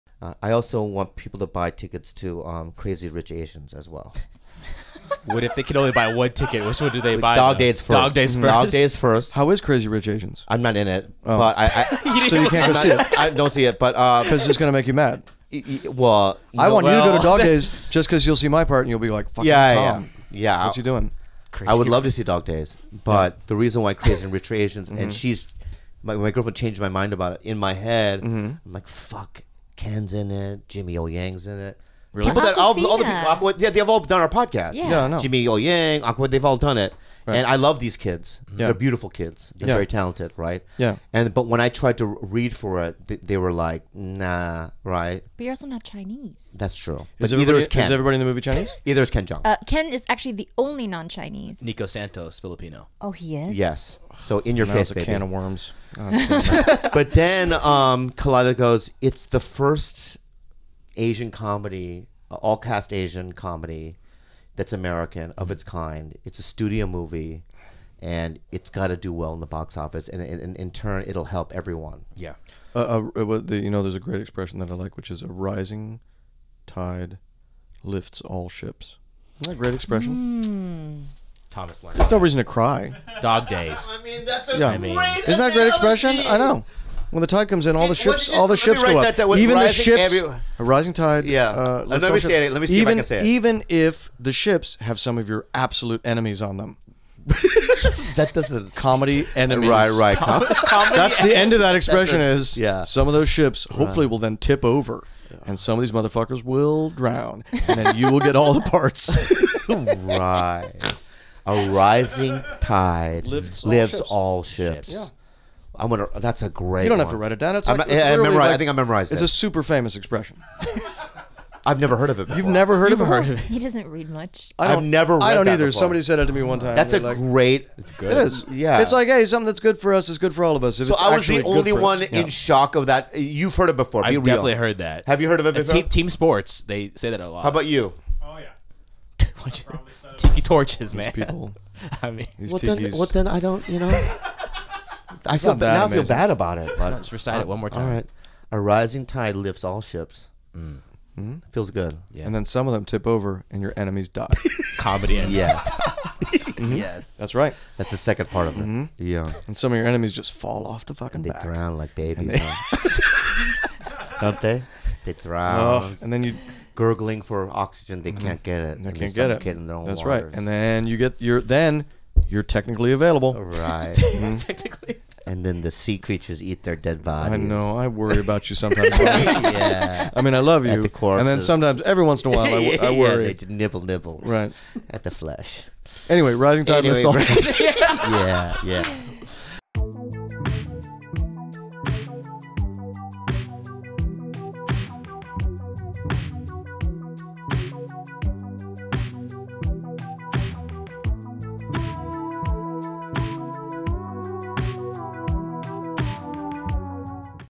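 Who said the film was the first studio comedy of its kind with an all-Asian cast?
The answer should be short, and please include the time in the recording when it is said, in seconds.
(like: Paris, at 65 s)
Khalyla, at 58 s.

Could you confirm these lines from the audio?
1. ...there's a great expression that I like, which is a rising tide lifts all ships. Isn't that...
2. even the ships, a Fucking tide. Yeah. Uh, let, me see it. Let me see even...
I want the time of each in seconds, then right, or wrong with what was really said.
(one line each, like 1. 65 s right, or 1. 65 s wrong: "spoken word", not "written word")
1. 73 s right
2. 89 s wrong: "rising", not "Fucking".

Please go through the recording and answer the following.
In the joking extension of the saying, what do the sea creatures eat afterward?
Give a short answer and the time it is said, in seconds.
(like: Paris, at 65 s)
their dead bodies, at 176 s.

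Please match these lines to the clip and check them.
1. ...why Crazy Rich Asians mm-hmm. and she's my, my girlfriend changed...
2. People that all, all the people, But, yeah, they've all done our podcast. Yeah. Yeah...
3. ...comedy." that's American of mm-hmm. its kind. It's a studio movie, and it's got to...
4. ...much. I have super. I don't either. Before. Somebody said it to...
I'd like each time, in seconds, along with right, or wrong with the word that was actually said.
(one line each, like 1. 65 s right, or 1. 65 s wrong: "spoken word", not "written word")
1. 23 s right
2. 32 s wrong: "Aqua", not "But"
3. 63 s right
4. 124 s wrong: "never", not "super".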